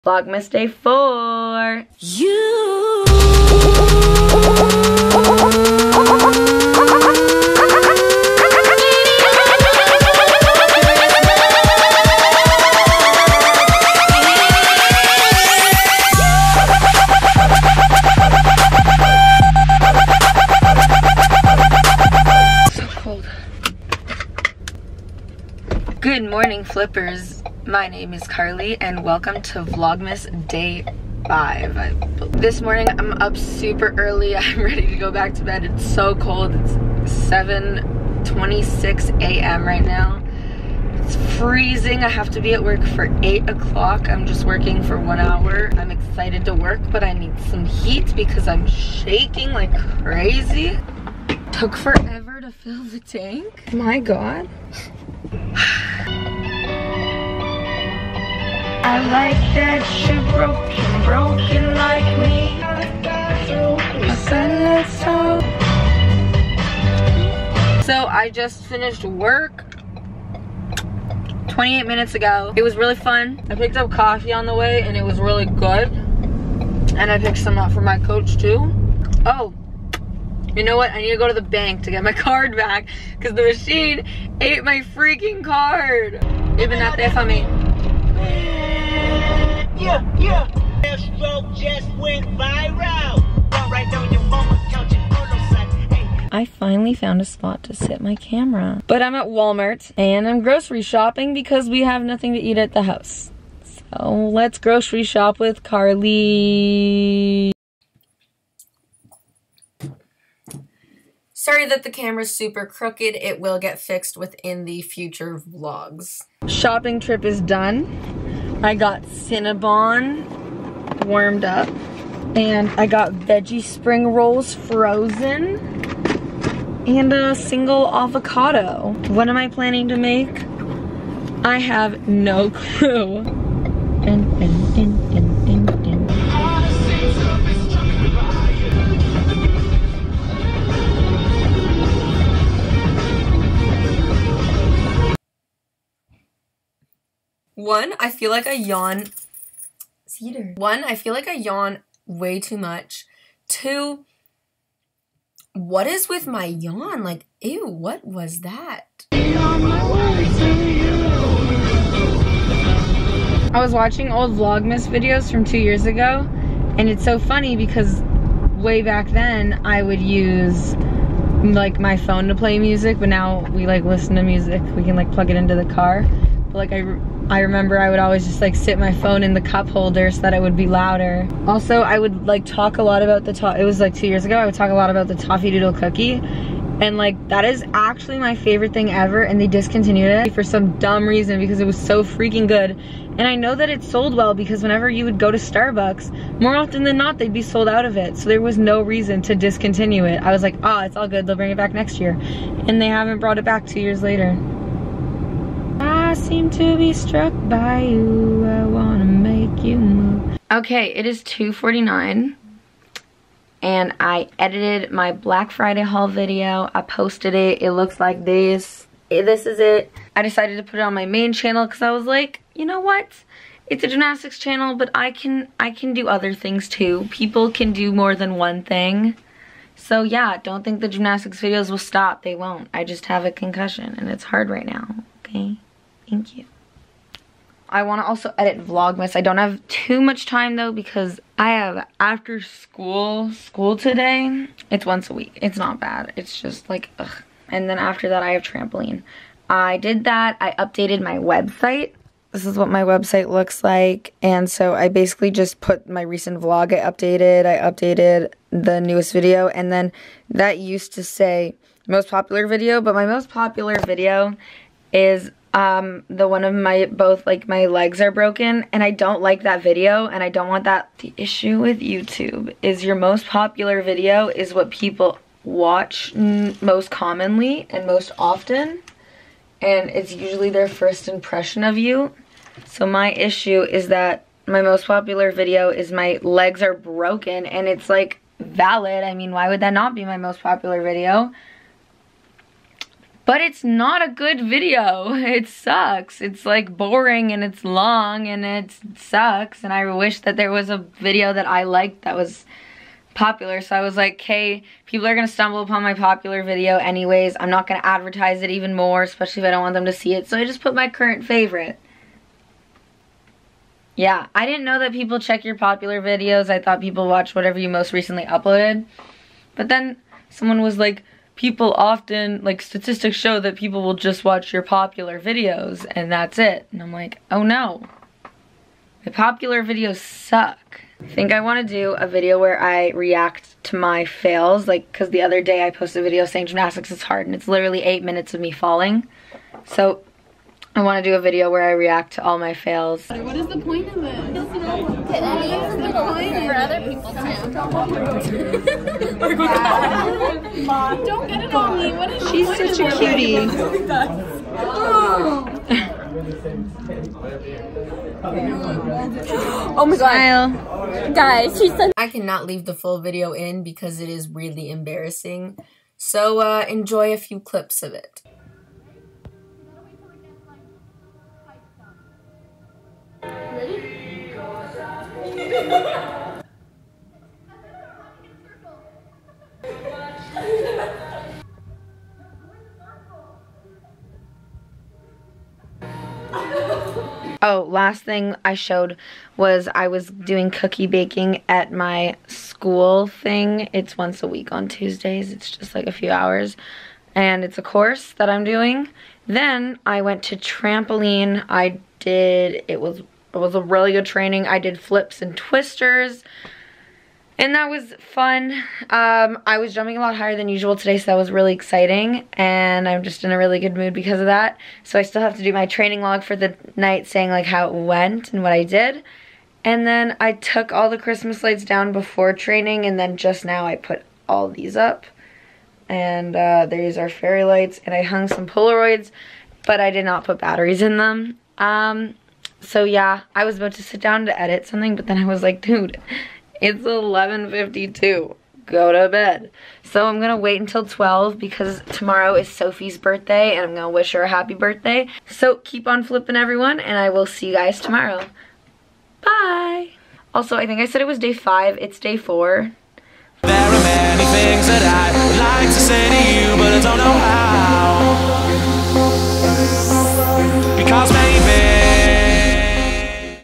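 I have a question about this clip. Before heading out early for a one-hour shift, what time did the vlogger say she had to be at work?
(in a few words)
8 o'clock.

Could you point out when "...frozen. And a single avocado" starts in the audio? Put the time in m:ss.
2:04.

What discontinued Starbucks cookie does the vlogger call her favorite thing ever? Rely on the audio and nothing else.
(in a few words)
Toffee Doodle cookie.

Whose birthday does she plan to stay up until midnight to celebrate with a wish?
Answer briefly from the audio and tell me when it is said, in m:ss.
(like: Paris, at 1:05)
Sophie, at 7:22.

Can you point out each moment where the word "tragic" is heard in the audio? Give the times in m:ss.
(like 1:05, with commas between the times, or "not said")
not said.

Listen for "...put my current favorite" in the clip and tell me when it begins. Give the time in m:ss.
5:10.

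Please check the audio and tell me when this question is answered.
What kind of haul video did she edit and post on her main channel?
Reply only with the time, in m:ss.
3:35.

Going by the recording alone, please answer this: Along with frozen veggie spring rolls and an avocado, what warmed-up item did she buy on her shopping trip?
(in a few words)
Cinnabon.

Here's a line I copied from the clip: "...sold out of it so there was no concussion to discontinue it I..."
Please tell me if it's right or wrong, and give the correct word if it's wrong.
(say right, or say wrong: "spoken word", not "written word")
wrong: "reason", not "concussion".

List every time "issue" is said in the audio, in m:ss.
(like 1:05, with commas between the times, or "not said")
4:31, 4:43.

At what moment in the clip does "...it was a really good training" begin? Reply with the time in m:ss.
6:42.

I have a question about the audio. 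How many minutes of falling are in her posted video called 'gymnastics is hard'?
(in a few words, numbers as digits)
8 minutes.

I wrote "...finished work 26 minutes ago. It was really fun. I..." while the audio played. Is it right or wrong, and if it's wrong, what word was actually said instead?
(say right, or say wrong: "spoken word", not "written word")
wrong: "28", not "26".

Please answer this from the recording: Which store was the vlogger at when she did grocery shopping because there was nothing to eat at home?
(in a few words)
Walmart.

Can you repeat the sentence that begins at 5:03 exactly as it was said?
So I was like, hey, people are going to stumble upon my popular video anyways.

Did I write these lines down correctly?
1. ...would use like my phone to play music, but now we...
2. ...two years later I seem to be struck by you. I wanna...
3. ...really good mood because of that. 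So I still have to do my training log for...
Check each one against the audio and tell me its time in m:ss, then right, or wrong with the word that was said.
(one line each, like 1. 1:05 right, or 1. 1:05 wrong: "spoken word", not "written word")
1. 2:49 right
2. 3:23 right
3. 6:53 right.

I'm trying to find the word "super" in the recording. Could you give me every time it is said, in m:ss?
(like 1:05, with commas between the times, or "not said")
0:33, 1:52.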